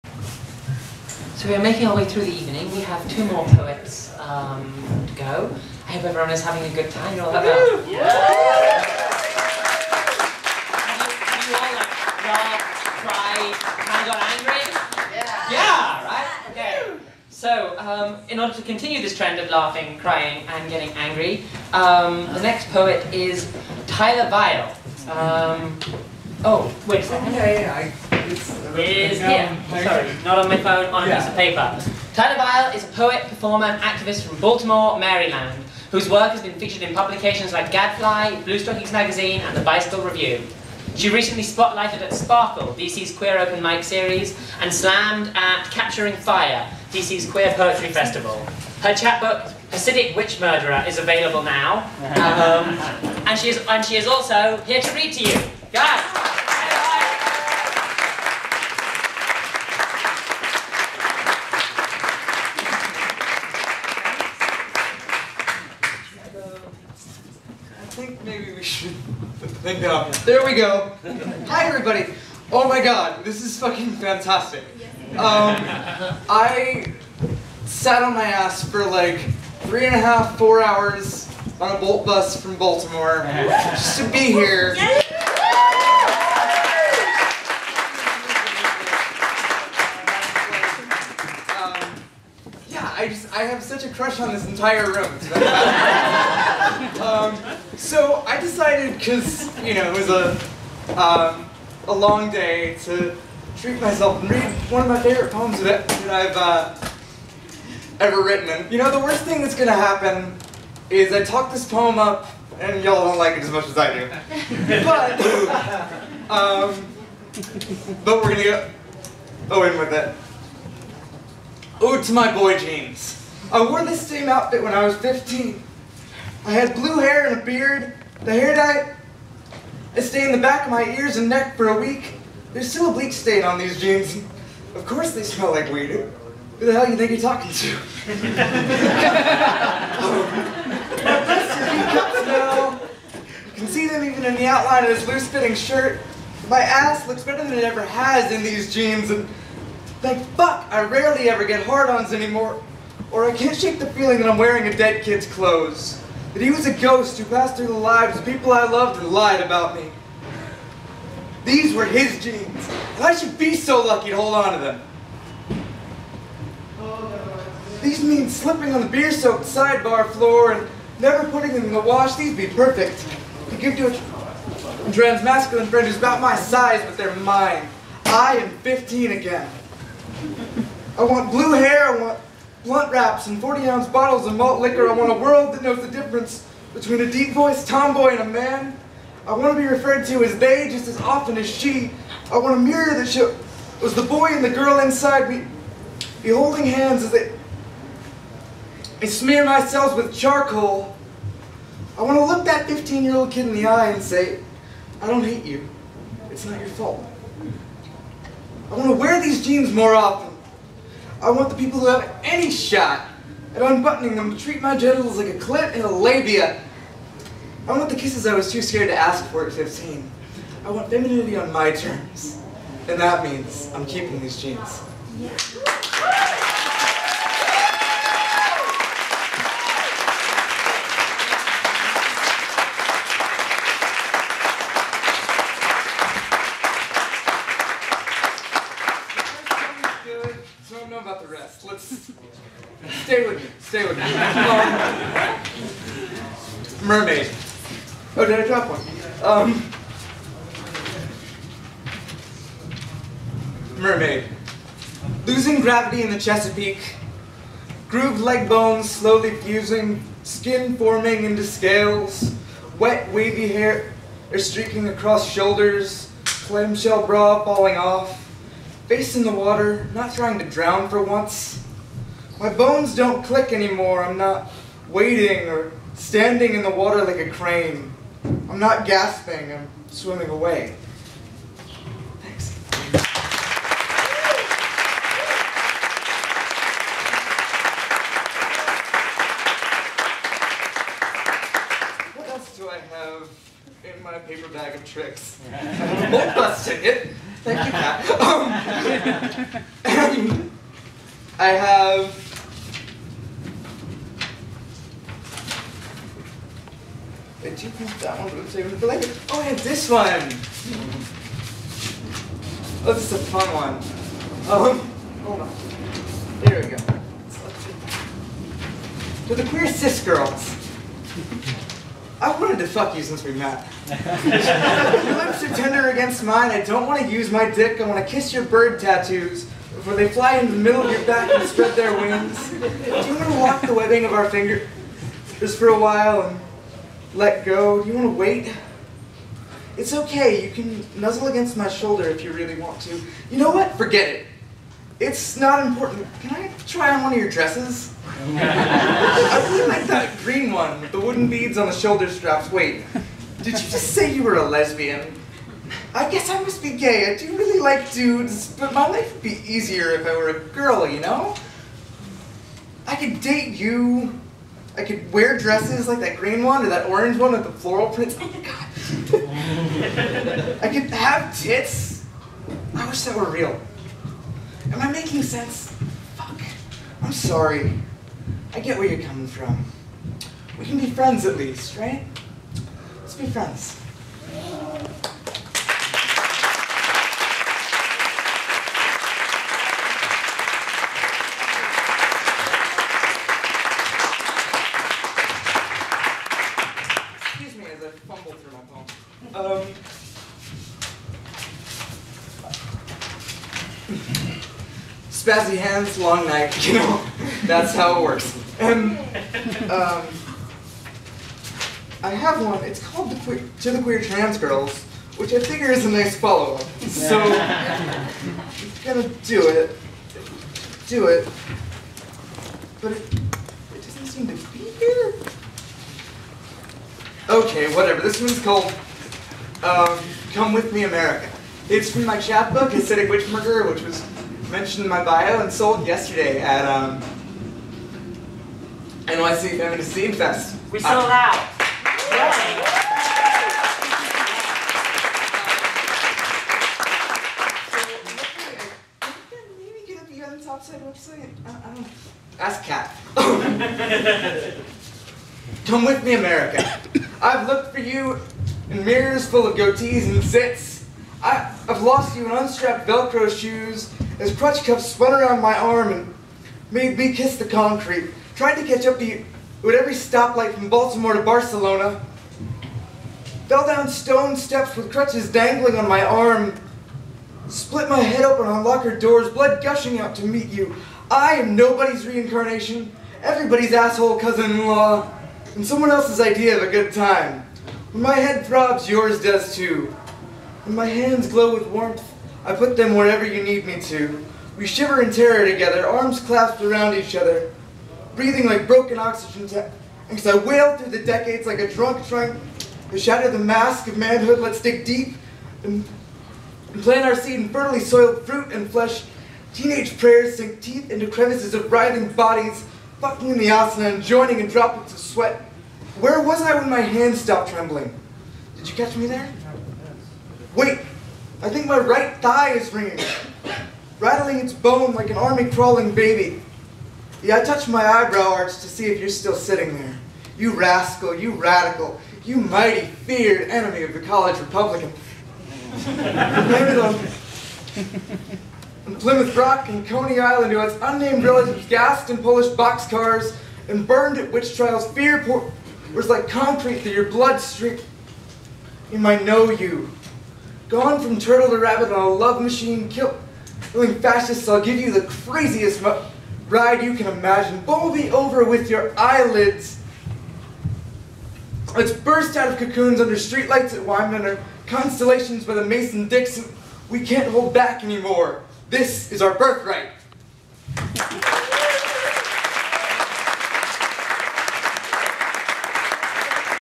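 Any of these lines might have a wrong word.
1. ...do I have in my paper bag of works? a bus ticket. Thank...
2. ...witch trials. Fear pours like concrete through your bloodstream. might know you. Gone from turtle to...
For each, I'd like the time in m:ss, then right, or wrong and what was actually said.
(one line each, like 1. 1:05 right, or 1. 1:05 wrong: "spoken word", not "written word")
1. 4:52 wrong: "tricks", not "works"
2. 9:04 right.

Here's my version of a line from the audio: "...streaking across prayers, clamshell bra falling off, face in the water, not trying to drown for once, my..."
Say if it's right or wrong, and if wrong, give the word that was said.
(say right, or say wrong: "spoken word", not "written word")
wrong: "shoulders", not "prayers".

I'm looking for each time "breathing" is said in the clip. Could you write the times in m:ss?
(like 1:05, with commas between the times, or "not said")
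8:18.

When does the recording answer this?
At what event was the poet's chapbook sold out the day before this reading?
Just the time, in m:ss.
7:19.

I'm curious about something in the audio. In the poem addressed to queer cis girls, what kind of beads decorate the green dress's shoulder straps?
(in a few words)
wooden.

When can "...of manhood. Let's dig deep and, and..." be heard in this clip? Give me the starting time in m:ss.
8:23.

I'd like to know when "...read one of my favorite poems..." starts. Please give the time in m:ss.
1:44.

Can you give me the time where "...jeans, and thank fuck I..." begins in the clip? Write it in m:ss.
2:28.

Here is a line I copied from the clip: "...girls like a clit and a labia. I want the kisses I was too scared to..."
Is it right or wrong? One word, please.
wrong.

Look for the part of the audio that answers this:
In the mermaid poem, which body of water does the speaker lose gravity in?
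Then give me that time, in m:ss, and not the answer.
4:16.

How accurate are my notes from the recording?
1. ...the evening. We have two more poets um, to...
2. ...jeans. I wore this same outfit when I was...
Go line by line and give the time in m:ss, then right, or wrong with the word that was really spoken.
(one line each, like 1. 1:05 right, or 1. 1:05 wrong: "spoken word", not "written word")
1. 0:02 right
2. 2:02 right.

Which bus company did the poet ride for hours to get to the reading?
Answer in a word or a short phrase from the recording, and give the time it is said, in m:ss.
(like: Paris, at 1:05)
Bolt bus, at 1:21.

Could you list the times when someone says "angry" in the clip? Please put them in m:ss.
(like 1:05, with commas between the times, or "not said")
0:14, 0:20.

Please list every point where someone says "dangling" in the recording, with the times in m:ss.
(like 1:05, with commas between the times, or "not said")
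7:55.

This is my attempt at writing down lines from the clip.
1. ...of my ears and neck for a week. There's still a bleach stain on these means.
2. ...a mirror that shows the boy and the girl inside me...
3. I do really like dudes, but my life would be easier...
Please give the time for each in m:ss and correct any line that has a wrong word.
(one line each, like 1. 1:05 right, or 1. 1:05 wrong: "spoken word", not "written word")
1. 2:10 wrong: "jeans", not "means"
2. 3:12 right
3. 5:57 right.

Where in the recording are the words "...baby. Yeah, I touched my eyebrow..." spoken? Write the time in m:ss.
8:45.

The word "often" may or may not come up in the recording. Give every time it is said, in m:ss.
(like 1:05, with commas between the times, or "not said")
3:11, 3:29.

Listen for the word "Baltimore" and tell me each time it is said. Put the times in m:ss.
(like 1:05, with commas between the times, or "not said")
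0:34, 1:22, 7:50.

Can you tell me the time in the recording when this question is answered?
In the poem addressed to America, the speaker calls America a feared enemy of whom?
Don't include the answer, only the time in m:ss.
8:54.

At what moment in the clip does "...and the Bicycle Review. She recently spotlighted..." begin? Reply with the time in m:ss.
0:39.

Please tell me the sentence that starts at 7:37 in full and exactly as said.
I've looked for you in mirrors full of goatees and zits.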